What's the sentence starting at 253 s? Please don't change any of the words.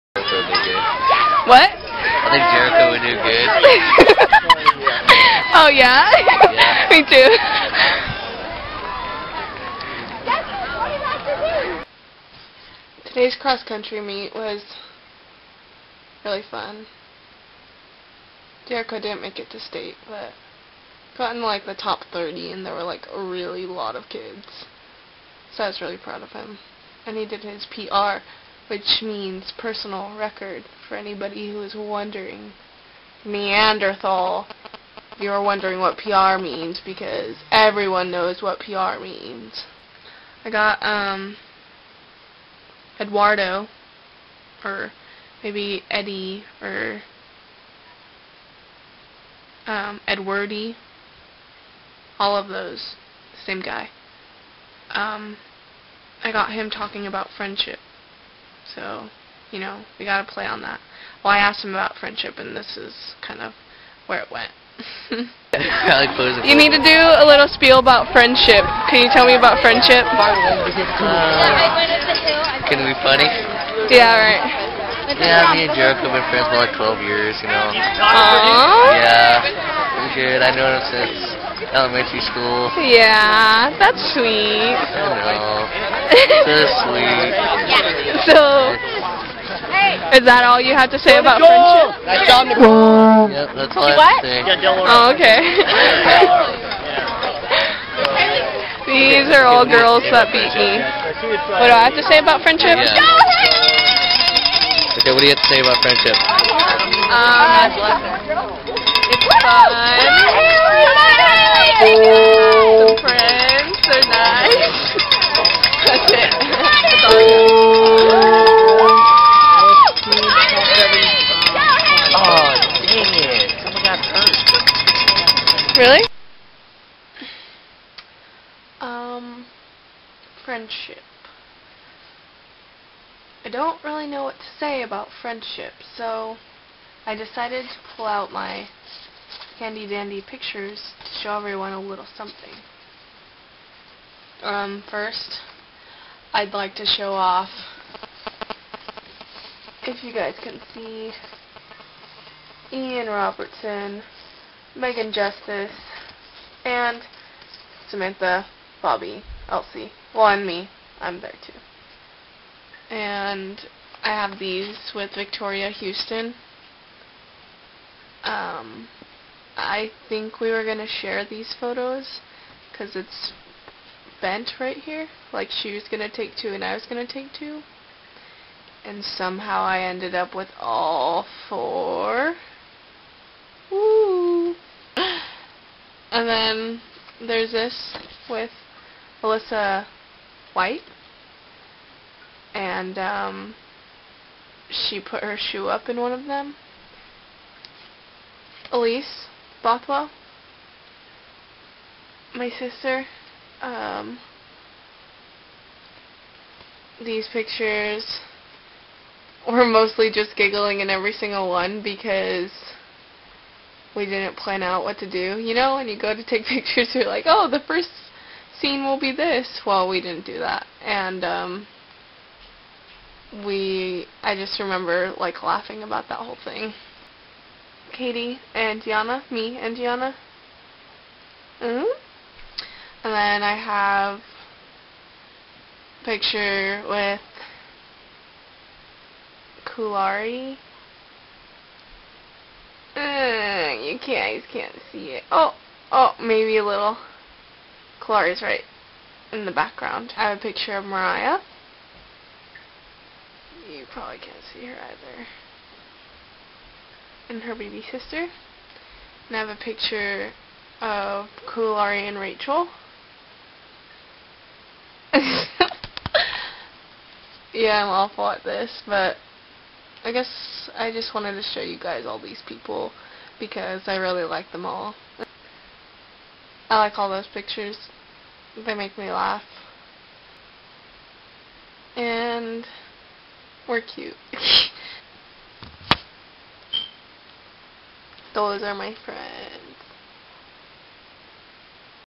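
You probably can't see her either.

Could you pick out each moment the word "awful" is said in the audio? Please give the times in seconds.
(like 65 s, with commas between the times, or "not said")
267 s.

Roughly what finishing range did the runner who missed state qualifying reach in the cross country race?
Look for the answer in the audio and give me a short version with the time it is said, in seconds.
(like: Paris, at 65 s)
top 30, at 21 s.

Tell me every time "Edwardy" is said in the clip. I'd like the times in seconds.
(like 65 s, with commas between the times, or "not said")
50 s.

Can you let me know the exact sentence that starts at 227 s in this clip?
Katie and Gianna, me and Gianna.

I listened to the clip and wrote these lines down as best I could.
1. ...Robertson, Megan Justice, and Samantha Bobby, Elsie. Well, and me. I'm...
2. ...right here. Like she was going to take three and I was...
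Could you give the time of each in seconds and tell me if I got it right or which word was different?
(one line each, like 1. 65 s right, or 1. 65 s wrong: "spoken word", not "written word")
1. 153 s right
2. 174 s wrong: "two", not "three".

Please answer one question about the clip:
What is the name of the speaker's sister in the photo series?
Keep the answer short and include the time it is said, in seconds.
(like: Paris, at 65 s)
Elise Bothwell, at 198 s.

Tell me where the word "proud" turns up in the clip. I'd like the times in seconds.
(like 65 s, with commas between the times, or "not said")
25 s.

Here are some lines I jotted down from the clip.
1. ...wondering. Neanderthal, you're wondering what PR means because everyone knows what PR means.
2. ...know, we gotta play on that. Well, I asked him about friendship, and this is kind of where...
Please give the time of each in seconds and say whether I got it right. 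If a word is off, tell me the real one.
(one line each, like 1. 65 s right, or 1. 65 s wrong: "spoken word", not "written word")
1. 31 s right
2. 59 s right.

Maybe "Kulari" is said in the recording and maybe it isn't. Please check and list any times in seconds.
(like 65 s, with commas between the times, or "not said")
239 s, 261 s.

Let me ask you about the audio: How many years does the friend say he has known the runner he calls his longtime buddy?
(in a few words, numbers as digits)
12 years.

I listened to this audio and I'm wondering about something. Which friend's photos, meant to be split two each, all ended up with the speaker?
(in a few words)
Victoria Houston.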